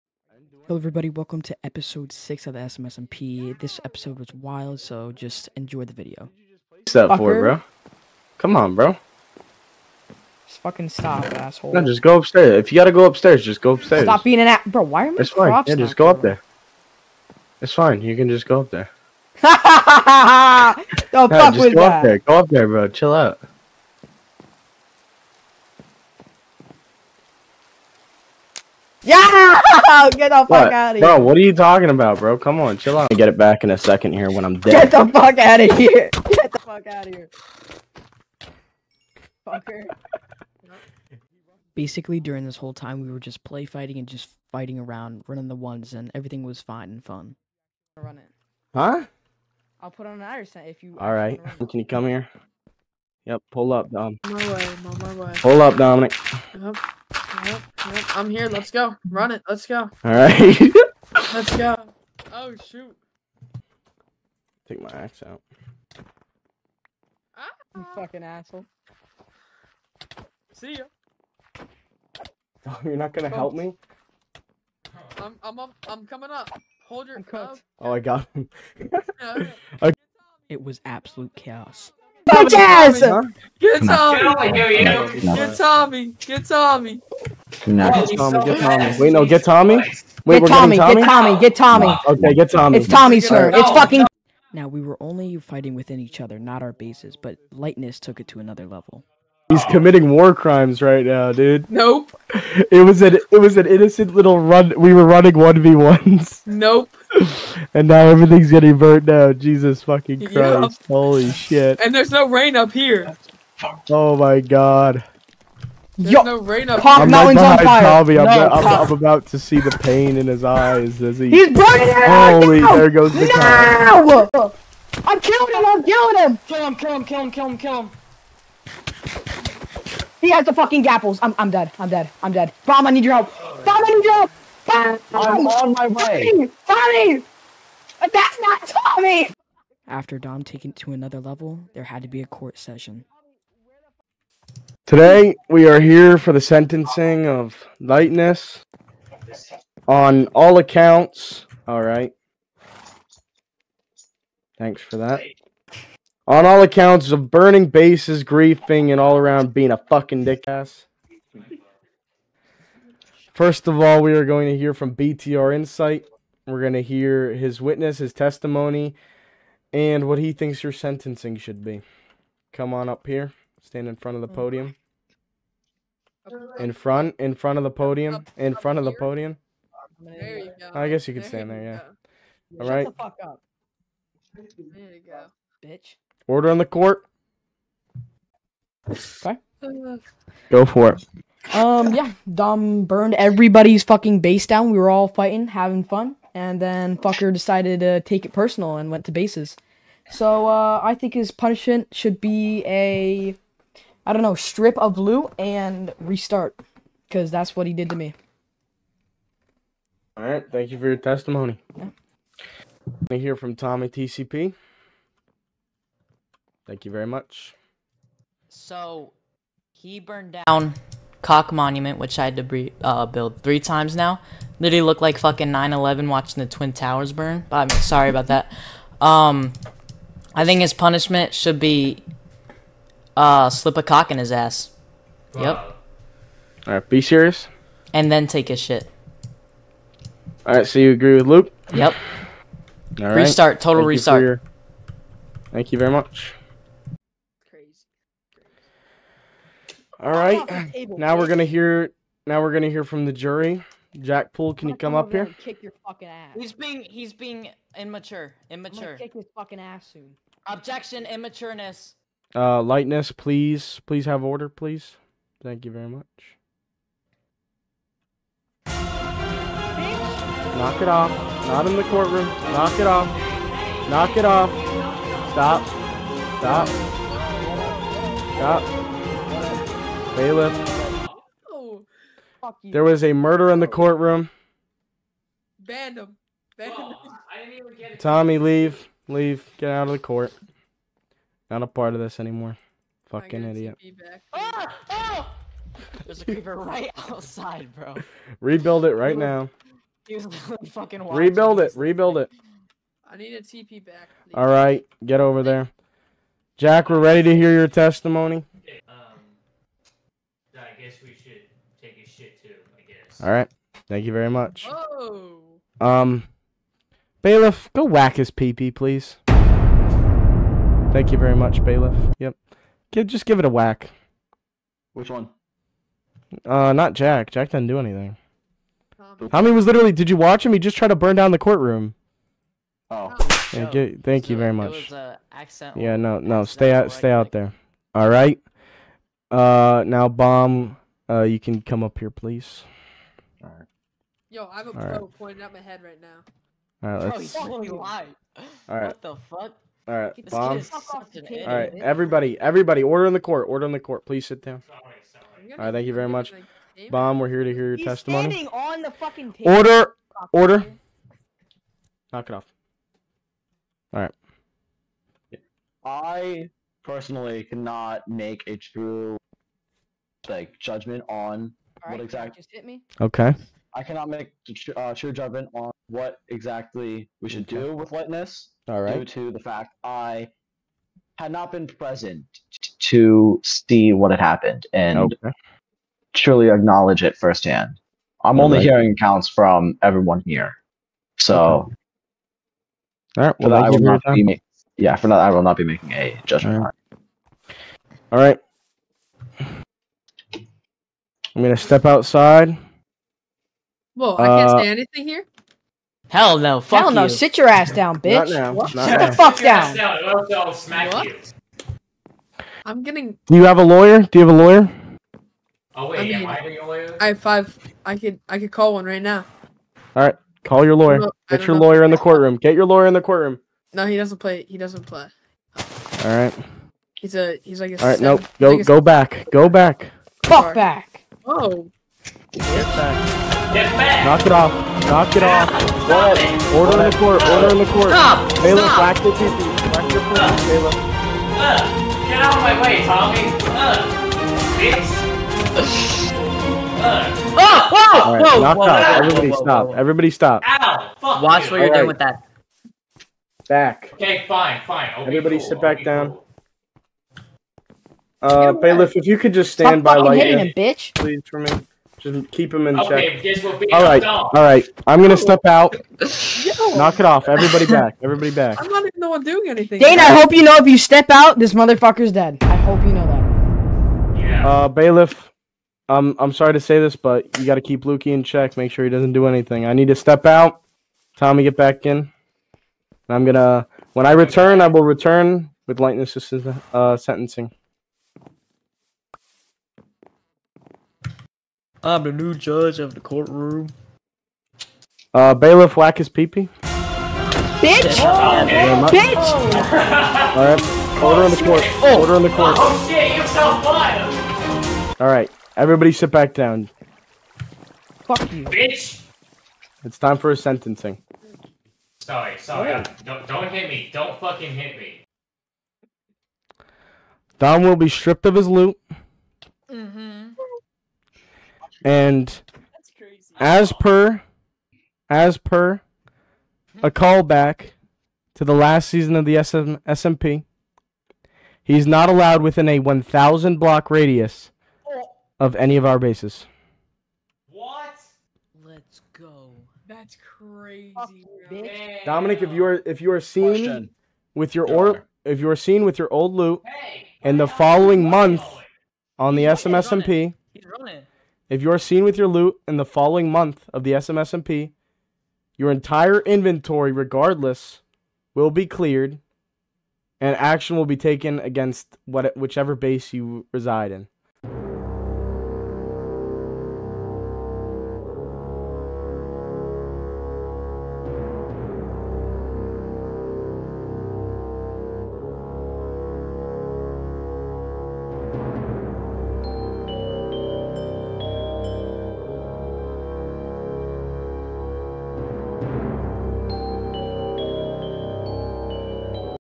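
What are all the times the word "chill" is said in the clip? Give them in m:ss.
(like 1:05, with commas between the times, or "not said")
0:22, 0:32.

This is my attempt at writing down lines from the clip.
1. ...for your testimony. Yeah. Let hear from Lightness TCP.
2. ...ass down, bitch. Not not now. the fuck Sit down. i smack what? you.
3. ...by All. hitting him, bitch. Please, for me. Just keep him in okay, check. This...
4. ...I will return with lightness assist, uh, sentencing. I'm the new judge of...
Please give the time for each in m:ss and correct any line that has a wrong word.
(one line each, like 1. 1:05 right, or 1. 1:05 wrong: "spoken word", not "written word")
1. 3:30 wrong: "Tommy", not "Lightness"
2. 6:47 right
3. 7:39 wrong: "Lightyear", not "All"
4. 8:04 right.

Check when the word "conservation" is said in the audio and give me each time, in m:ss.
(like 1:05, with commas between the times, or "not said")
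not said.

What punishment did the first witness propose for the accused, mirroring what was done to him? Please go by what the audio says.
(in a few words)
strip of loot and restart.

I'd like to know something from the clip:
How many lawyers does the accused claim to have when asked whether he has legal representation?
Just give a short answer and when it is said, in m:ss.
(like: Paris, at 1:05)
5, at 6:56.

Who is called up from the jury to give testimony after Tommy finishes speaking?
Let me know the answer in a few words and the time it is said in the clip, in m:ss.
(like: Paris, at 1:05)
Jack Poole, at 4:13.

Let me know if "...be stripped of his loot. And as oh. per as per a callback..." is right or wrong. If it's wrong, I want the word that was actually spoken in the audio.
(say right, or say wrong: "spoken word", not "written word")
right.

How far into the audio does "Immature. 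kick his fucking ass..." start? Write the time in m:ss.
4:18.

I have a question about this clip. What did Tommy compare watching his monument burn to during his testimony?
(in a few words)
9-11.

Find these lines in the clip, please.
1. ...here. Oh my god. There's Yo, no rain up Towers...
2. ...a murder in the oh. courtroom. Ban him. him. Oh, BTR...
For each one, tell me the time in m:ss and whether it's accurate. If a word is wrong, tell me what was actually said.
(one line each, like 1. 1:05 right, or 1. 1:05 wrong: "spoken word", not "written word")
1. 1:52 wrong: "Pop", not "Towers"
2. 4:43 wrong: "Tommy", not "BTR".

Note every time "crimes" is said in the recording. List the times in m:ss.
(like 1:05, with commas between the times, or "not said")
1:40.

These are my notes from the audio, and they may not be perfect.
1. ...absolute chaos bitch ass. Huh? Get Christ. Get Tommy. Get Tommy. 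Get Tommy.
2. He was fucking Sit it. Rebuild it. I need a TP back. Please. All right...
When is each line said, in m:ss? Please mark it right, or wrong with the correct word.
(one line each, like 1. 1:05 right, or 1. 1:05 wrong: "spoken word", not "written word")
1. 1:20 wrong: "Tommy", not "Christ"
2. 5:00 wrong: "Rebuild", not "Sit".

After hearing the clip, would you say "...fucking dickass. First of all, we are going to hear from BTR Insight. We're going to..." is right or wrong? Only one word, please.
right.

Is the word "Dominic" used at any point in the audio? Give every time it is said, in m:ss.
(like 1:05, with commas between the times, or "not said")
0:55, 9:02.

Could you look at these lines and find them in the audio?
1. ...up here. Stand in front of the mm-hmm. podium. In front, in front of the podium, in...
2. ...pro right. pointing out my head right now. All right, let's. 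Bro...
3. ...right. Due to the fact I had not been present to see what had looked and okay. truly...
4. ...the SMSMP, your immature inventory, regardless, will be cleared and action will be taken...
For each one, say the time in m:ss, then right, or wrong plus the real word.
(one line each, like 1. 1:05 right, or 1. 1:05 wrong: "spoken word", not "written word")
1. 2:52 right
2. 5:44 right
3. 6:18 wrong: "happened", not "looked"
4. 9:13 wrong: "entire", not "immature".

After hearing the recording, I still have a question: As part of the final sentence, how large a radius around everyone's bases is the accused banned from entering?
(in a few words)
1,000 block.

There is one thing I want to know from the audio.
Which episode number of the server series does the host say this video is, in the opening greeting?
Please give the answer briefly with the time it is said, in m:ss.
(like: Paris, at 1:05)
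6, at 0:01.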